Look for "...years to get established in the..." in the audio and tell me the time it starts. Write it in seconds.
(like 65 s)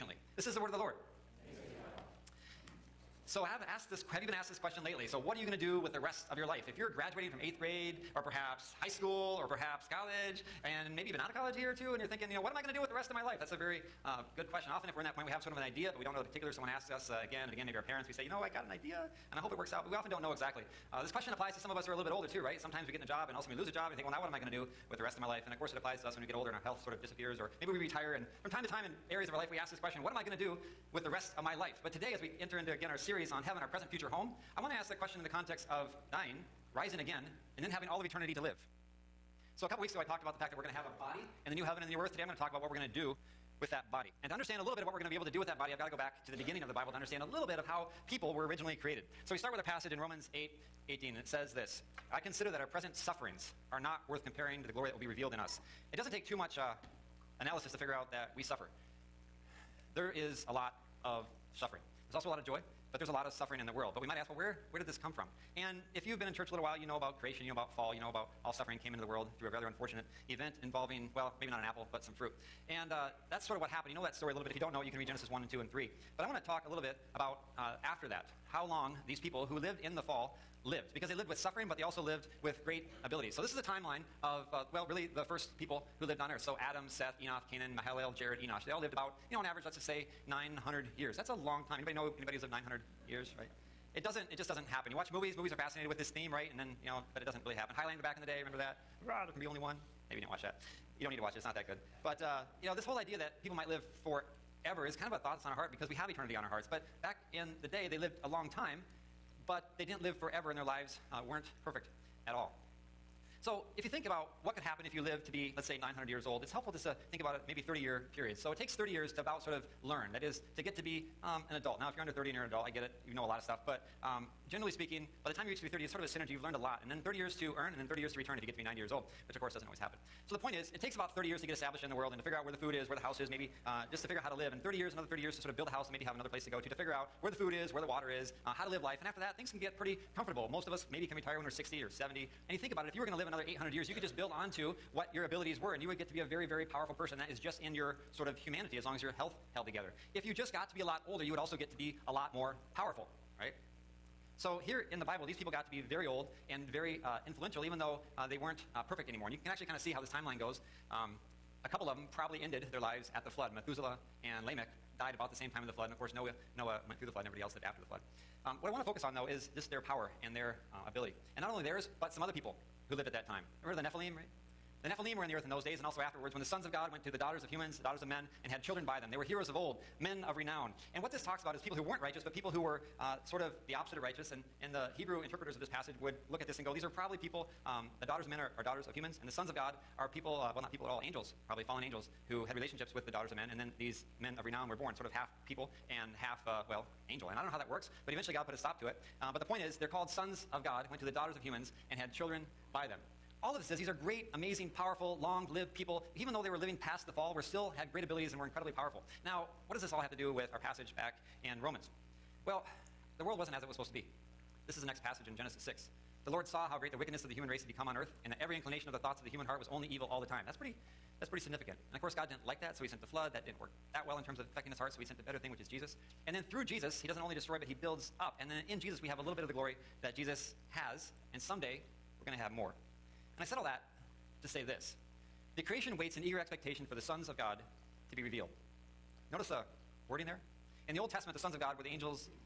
131 s.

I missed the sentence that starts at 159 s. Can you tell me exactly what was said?
And you can actually kind of see how this timeline goes.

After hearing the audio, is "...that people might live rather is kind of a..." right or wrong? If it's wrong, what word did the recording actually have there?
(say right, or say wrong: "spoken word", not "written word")
wrong: "forever", not "rather".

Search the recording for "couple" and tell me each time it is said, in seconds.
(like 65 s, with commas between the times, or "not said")
39 s, 161 s.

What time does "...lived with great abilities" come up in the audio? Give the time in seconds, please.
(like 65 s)
82 s.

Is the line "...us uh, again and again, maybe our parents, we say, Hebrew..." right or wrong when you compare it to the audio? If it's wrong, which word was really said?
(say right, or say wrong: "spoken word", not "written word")
wrong: "You", not "Hebrew".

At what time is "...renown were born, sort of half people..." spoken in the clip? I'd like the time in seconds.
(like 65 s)
194 s.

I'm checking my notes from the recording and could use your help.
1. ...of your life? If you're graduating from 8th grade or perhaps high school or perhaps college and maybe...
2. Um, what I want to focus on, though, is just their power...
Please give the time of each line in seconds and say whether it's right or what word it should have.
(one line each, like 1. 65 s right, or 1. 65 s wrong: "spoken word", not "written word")
1. 6 s right
2. 168 s right.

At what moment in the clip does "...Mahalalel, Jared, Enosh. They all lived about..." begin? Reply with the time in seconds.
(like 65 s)
87 s.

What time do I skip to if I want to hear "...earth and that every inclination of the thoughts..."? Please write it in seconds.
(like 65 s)
217 s.